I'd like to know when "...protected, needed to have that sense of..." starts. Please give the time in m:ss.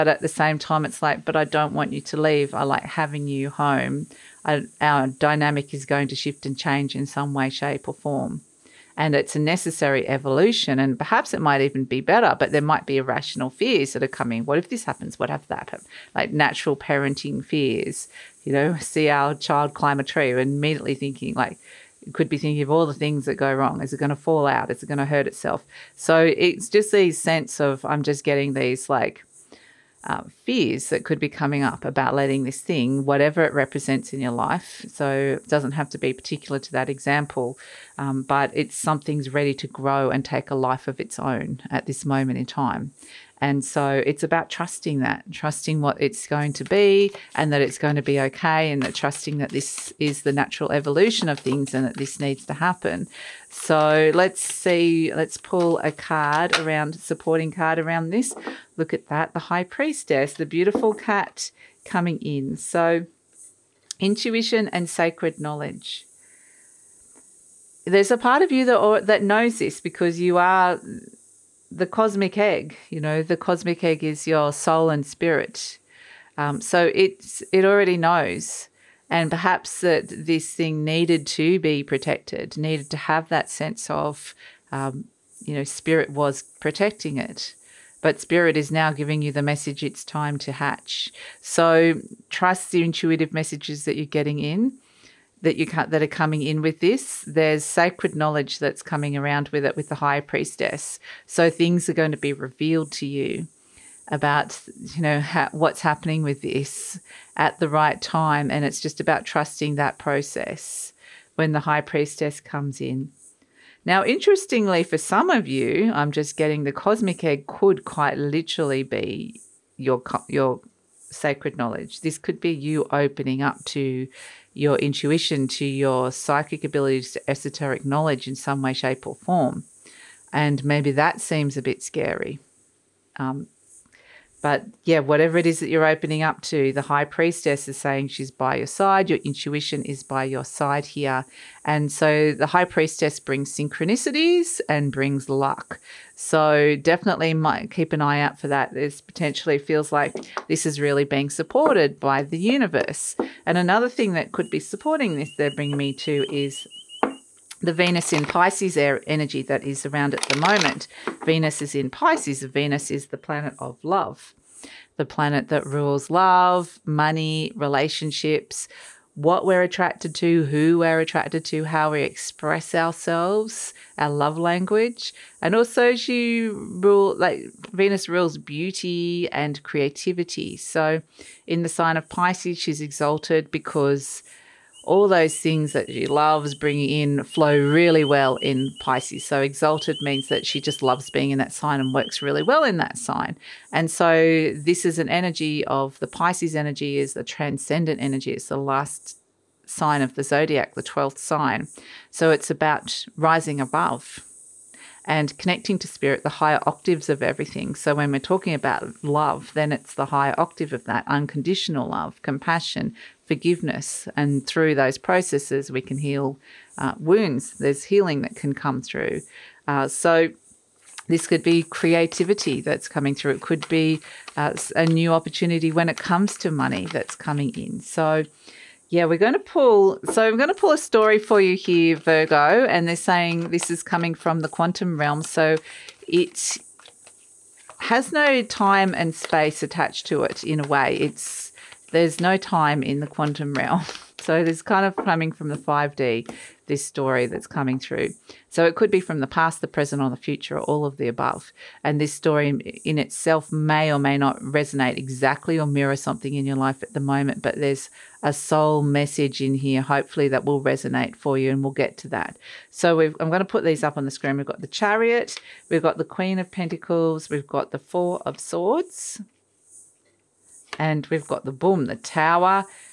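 1:21.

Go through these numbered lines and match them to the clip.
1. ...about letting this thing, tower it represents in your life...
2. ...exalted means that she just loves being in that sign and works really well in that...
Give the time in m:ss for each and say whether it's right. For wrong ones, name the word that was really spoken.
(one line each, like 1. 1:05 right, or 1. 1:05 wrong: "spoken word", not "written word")
1. 0:31 wrong: "whatever", not "tower"
2. 3:09 right.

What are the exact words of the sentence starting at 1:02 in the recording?
So intuition and sacred knowledge there's a part of you that or, that knows this because you are the cosmic egg.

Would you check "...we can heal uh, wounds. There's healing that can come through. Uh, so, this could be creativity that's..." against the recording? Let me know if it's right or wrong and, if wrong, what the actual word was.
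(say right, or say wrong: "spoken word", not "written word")
right.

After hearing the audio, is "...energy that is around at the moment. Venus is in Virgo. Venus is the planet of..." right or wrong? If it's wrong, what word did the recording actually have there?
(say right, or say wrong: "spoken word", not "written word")
wrong: "Pisces", not "Virgo".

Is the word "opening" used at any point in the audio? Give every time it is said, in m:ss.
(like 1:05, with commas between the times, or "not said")
2:02, 2:15.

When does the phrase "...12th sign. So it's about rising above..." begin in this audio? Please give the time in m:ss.
3:20.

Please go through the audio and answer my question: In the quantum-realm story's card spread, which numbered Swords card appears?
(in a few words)
Four of Swords.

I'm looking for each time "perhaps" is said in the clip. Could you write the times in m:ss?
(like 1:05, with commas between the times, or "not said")
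0:10, 1:19.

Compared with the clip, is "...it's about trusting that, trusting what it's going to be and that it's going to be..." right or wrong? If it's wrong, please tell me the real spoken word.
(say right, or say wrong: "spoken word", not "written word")
right.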